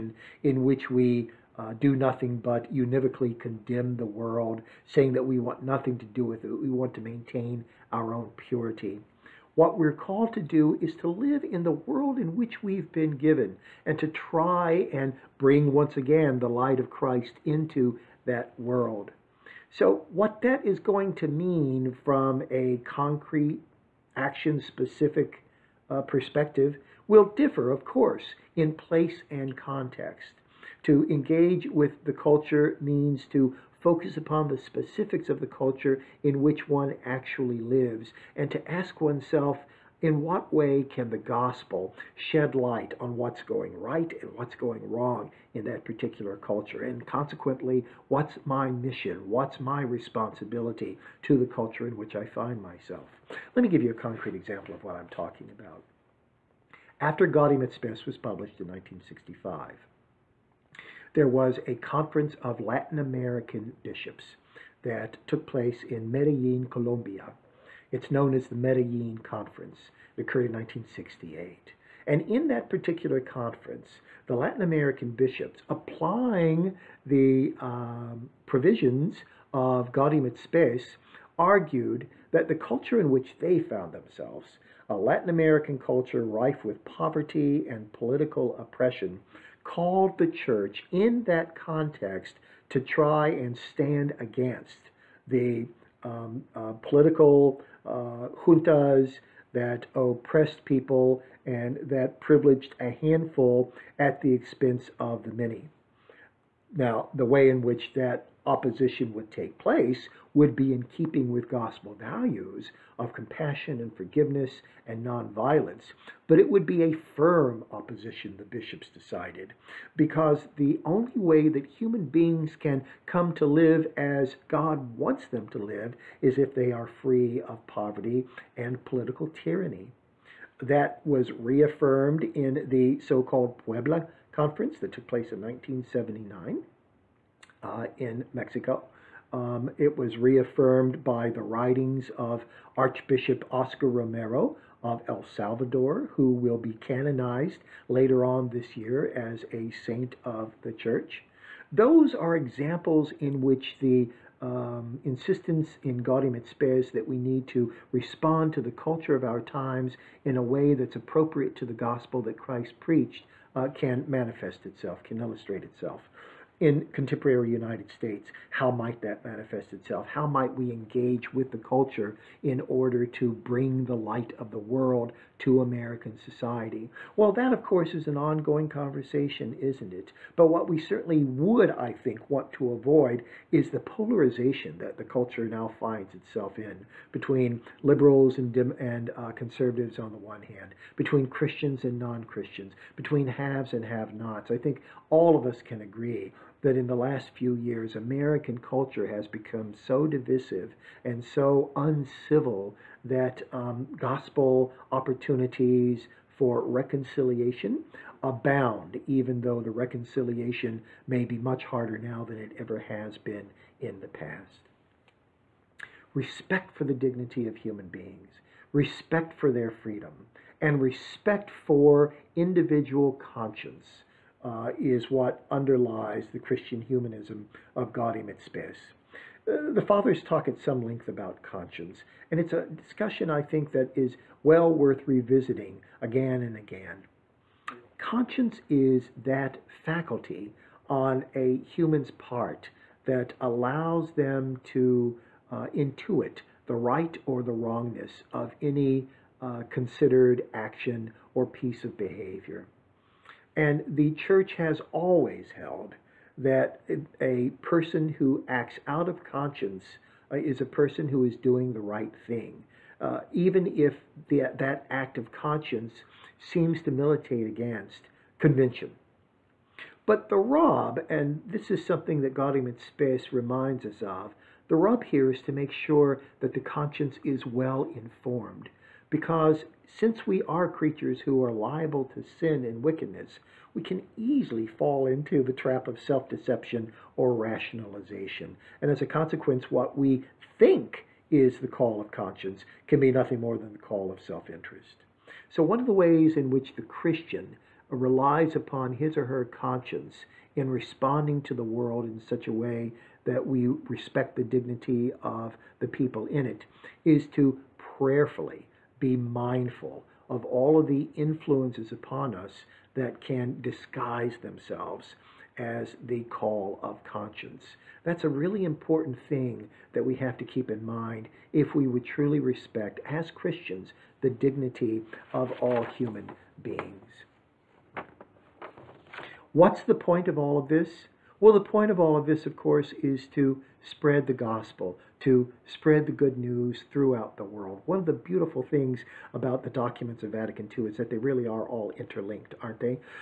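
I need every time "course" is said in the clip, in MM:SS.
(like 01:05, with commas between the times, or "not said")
00:27, 02:57, 05:32.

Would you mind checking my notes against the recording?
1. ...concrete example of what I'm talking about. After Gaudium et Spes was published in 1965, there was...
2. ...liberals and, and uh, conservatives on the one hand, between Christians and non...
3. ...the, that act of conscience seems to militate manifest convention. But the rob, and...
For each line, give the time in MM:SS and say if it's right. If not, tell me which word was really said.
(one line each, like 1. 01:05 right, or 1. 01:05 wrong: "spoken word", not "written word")
1. 00:54 right
2. 03:07 right
3. 04:24 wrong: "against", not "manifest".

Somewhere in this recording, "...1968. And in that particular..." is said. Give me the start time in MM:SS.
01:10.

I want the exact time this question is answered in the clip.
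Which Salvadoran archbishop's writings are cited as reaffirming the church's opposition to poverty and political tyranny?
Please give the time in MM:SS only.
02:23.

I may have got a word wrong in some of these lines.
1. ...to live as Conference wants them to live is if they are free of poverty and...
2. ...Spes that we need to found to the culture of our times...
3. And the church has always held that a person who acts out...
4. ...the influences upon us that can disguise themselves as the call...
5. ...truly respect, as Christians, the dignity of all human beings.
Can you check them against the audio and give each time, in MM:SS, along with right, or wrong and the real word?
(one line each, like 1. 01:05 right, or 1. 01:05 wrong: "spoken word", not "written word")
1. 02:03 wrong: "God", not "Conference"
2. 02:36 wrong: "respond", not "found"
3. 04:13 right
4. 05:10 right
5. 05:22 right.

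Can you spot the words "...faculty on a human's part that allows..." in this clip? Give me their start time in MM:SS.
03:59.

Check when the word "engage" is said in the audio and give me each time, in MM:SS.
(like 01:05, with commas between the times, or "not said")
00:31, 02:50.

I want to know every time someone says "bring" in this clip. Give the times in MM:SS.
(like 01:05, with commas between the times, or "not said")
00:15, 02:53.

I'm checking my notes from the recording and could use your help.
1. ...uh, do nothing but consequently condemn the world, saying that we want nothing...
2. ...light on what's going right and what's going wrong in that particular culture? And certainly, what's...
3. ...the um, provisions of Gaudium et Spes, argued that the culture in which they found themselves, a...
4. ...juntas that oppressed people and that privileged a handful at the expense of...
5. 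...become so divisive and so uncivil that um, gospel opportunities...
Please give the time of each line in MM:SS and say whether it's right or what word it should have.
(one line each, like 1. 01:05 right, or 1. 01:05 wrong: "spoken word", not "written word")
1. 00:01 wrong: "univocally", not "consequently"
2. 00:42 wrong: "consequently", not "certainly"
3. 01:17 right
4. 01:38 right
5. 03:19 right.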